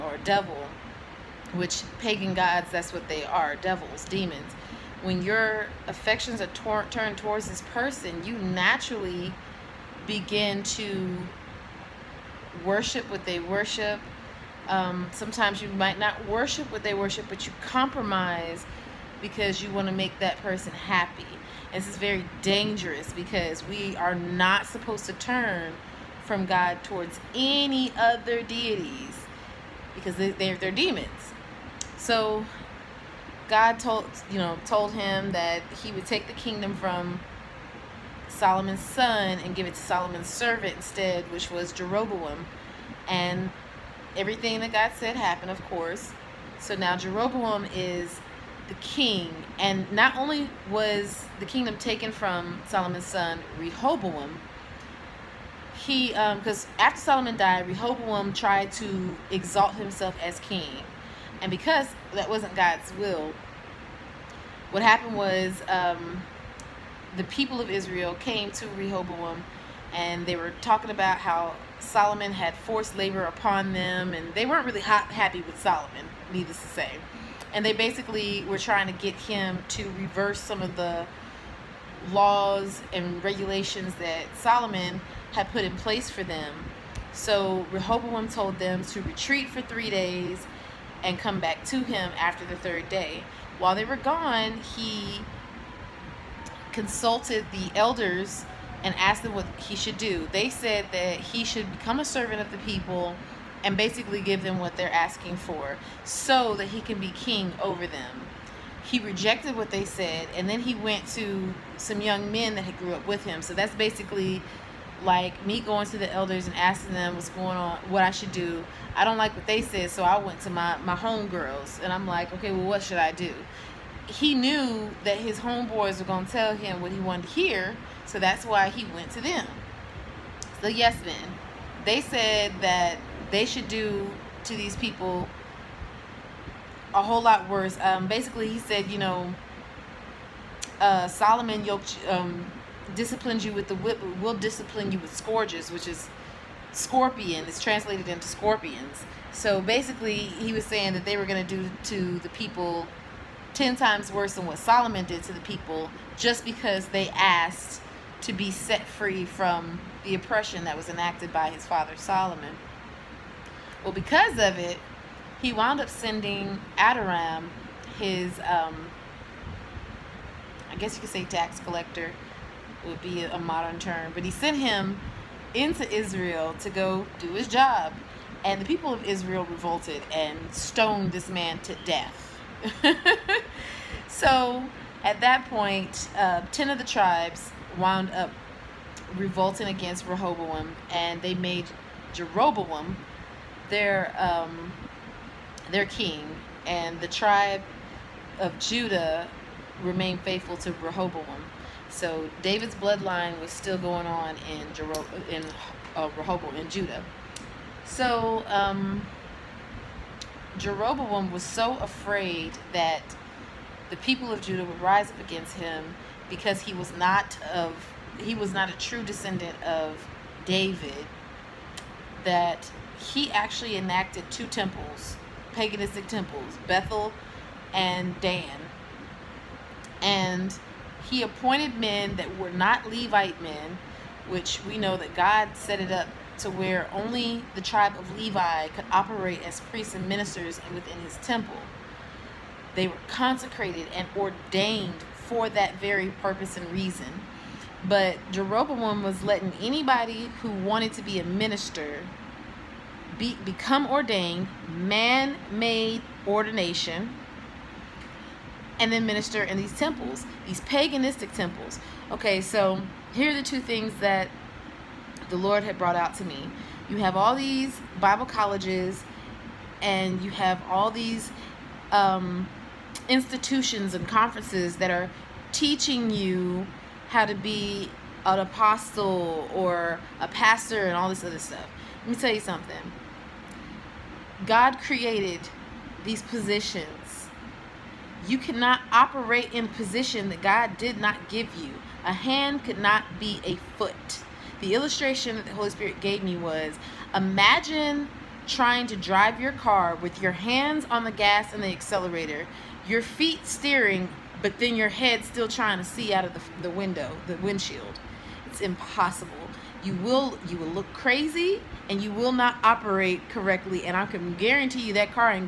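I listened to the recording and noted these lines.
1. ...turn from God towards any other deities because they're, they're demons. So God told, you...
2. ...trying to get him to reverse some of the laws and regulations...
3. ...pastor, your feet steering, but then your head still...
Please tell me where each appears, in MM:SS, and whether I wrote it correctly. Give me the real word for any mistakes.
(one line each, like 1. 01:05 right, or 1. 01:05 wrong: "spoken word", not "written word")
1. 00:25 right
2. 01:18 right
3. 05:01 wrong: "accelerator", not "pastor".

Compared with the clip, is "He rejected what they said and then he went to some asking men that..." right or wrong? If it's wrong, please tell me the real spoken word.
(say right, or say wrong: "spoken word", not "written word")
wrong: "young", not "asking".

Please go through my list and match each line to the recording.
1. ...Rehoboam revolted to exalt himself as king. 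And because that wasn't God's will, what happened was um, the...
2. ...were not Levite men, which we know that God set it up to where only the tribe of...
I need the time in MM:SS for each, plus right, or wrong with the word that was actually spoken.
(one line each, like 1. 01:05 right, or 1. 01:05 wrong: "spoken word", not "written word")
1. 00:57 wrong: "tried", not "revolted"
2. 03:52 right.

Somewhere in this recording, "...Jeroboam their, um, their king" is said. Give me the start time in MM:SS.
03:12.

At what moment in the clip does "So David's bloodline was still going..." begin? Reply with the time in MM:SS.
03:21.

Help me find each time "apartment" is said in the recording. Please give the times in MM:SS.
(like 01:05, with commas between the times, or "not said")
not said.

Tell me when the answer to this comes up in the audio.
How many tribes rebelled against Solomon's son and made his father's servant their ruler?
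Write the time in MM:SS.
03:06.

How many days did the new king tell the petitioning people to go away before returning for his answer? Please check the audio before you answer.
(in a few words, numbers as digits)
3.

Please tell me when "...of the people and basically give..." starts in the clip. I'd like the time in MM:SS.
01:42.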